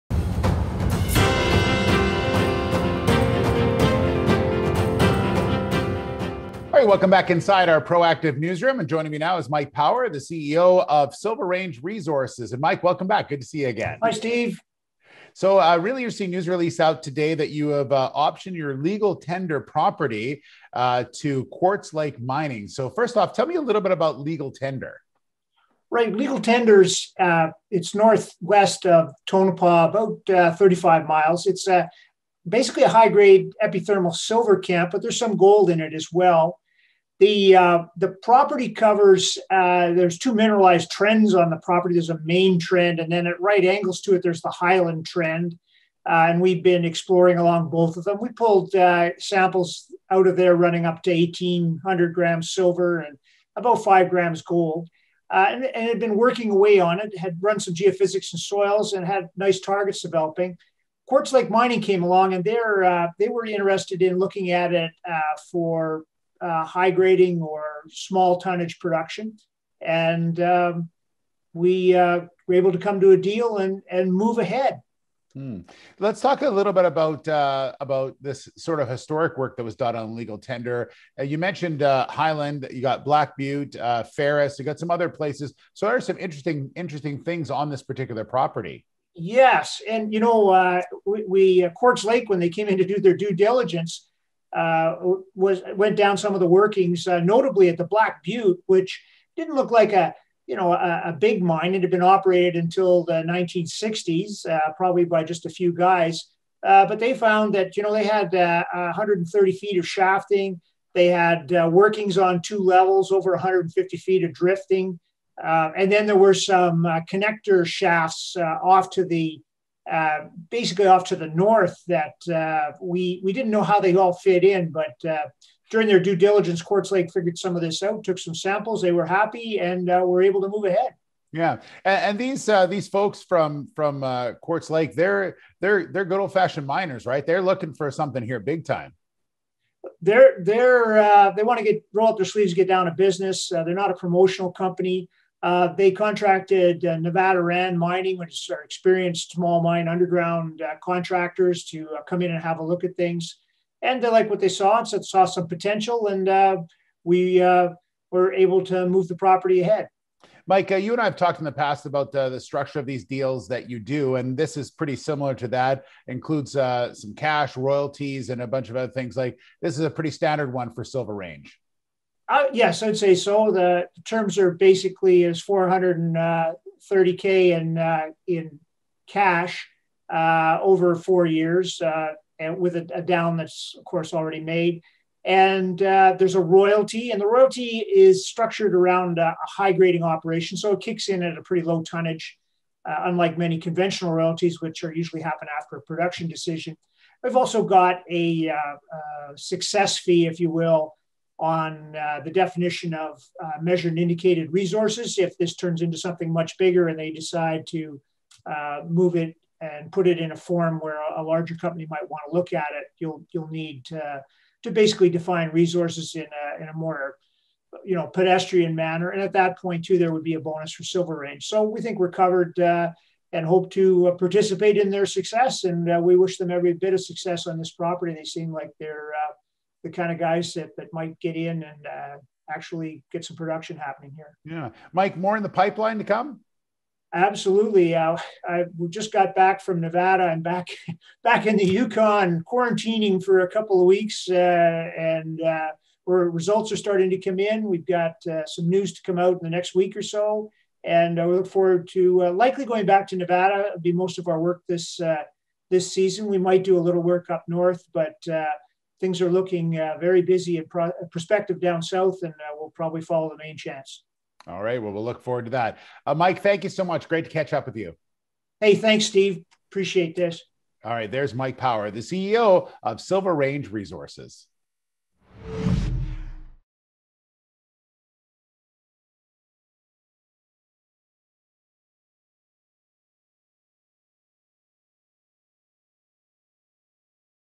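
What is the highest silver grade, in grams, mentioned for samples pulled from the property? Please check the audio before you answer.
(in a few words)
1,800 grams.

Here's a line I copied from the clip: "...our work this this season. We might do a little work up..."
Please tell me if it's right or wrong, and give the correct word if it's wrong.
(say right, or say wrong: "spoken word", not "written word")
right.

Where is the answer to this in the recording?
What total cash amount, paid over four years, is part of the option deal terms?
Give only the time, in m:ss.
2:55.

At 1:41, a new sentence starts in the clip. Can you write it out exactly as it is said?
It had been operated until the 1960s, uh, probably by just a few guys.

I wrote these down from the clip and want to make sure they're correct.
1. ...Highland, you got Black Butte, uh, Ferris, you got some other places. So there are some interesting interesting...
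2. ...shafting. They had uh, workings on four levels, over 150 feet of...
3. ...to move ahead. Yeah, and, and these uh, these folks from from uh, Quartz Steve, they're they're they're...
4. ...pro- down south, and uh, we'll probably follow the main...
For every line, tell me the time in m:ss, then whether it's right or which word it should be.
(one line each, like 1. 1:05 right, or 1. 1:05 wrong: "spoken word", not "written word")
1. 1:22 right
2. 1:49 wrong: "two", not "four"
3. 2:10 wrong: "Lake", not "Steve"
4. 4:20 right.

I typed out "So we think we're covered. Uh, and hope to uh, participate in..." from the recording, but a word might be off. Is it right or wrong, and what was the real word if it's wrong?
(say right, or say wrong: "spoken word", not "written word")
right.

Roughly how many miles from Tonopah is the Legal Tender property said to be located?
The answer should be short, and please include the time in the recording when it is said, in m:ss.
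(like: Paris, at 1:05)
35 miles, at 0:29.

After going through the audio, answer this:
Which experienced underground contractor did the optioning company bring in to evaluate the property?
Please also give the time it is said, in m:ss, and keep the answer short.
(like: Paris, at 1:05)
Nevada Rand Mining, at 2:26.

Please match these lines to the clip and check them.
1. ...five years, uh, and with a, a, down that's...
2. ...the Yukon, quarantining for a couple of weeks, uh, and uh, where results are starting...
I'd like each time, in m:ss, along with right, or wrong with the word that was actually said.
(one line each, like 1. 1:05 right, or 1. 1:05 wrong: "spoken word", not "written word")
1. 3:00 wrong: "four", not "five"
2. 4:01 right.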